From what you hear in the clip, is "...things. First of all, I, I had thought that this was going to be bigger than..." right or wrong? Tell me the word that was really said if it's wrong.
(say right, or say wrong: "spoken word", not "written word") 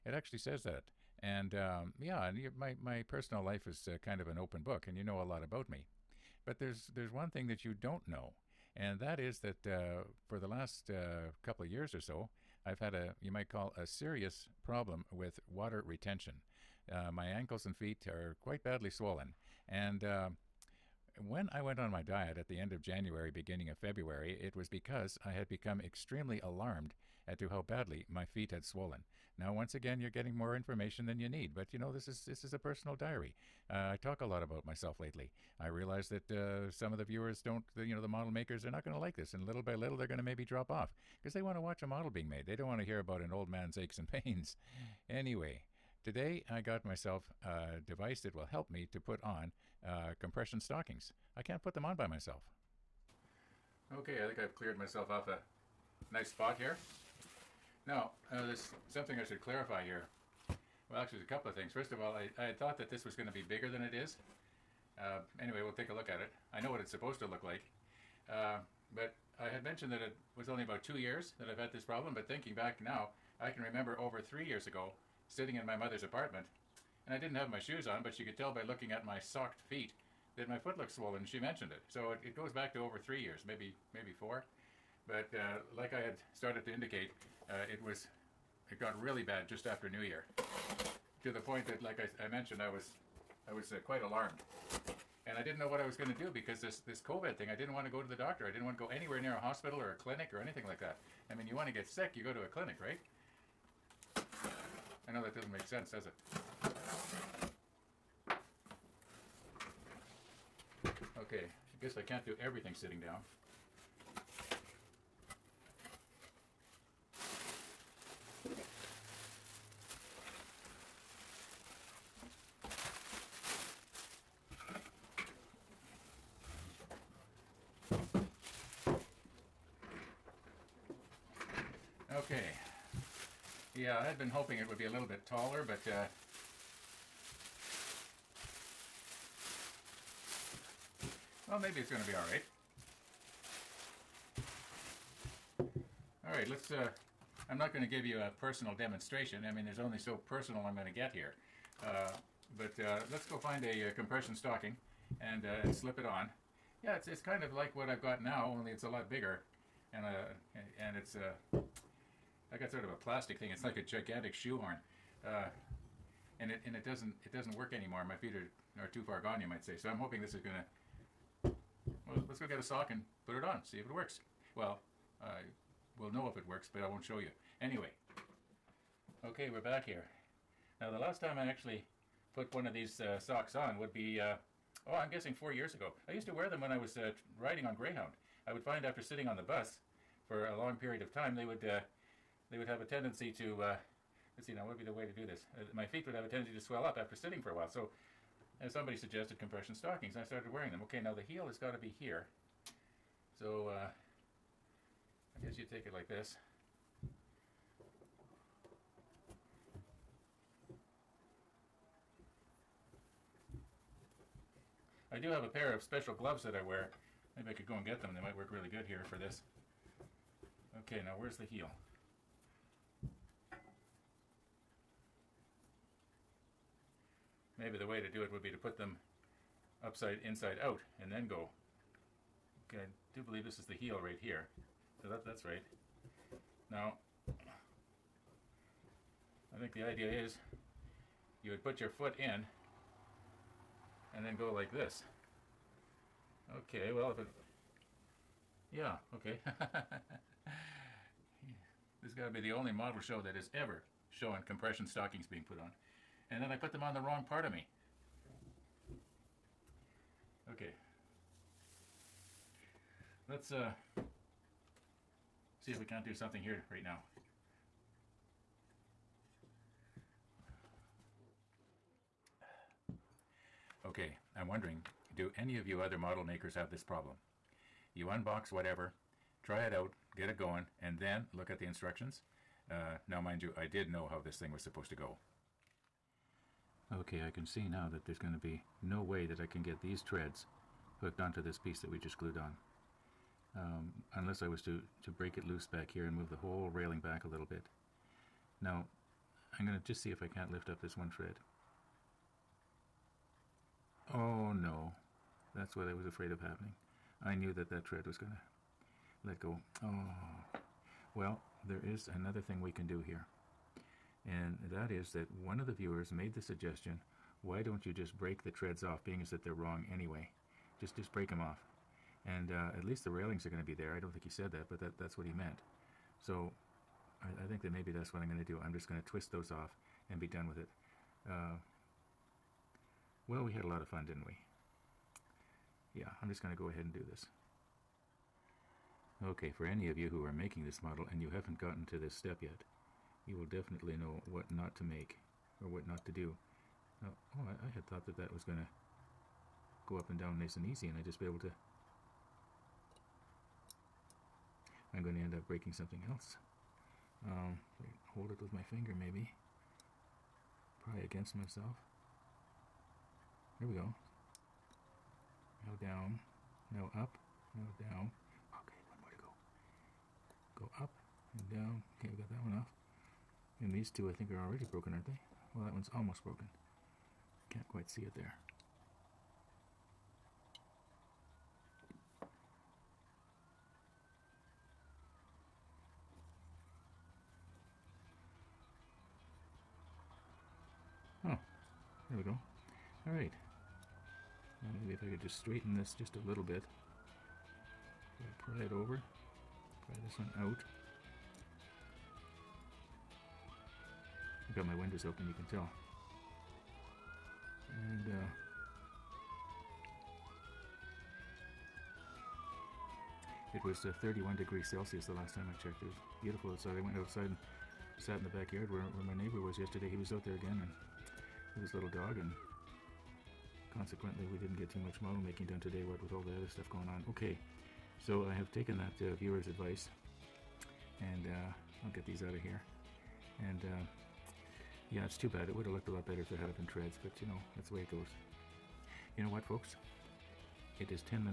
right.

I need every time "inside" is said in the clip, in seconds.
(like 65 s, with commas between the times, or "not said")
230 s.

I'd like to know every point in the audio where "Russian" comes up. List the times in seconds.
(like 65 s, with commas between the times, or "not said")
not said.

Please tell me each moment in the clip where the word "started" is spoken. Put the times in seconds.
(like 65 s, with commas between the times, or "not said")
86 s, 200 s.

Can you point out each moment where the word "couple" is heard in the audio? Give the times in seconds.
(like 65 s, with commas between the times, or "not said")
11 s, 61 s.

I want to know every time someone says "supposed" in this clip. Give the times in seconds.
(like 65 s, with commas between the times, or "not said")
66 s, 284 s.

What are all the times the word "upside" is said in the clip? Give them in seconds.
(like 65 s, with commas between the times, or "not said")
229 s.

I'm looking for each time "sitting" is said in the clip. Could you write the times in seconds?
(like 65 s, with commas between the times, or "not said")
75 s, 112 s, 189 s, 197 s.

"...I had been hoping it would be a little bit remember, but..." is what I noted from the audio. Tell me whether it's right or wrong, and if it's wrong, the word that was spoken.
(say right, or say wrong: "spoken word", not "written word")
wrong: "taller", not "remember".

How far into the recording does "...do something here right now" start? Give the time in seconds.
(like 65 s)
266 s.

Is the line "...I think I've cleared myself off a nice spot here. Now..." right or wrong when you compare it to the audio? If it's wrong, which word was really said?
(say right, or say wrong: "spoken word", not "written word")
right.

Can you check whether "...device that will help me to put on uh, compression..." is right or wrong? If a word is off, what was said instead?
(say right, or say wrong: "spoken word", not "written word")
right.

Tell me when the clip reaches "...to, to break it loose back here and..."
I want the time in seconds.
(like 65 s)
294 s.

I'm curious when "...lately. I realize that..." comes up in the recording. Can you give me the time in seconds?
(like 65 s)
34 s.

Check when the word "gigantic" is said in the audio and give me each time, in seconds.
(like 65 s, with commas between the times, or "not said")
163 s.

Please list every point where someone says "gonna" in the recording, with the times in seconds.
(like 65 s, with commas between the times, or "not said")
170 s.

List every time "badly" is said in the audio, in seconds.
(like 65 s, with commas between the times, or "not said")
18 s, 27 s.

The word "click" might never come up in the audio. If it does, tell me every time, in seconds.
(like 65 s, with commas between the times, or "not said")
not said.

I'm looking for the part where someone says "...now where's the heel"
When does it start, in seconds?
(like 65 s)
221 s.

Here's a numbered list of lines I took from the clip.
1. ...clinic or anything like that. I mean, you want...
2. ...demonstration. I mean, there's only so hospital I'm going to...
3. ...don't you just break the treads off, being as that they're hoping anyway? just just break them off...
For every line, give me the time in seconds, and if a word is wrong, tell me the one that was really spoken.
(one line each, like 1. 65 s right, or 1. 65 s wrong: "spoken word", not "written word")
1. 99 s right
2. 148 s wrong: "personal", not "hospital"
3. 317 s wrong: "wrong", not "hoping".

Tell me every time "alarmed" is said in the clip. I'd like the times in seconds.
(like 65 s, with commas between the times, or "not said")
26 s, 94 s.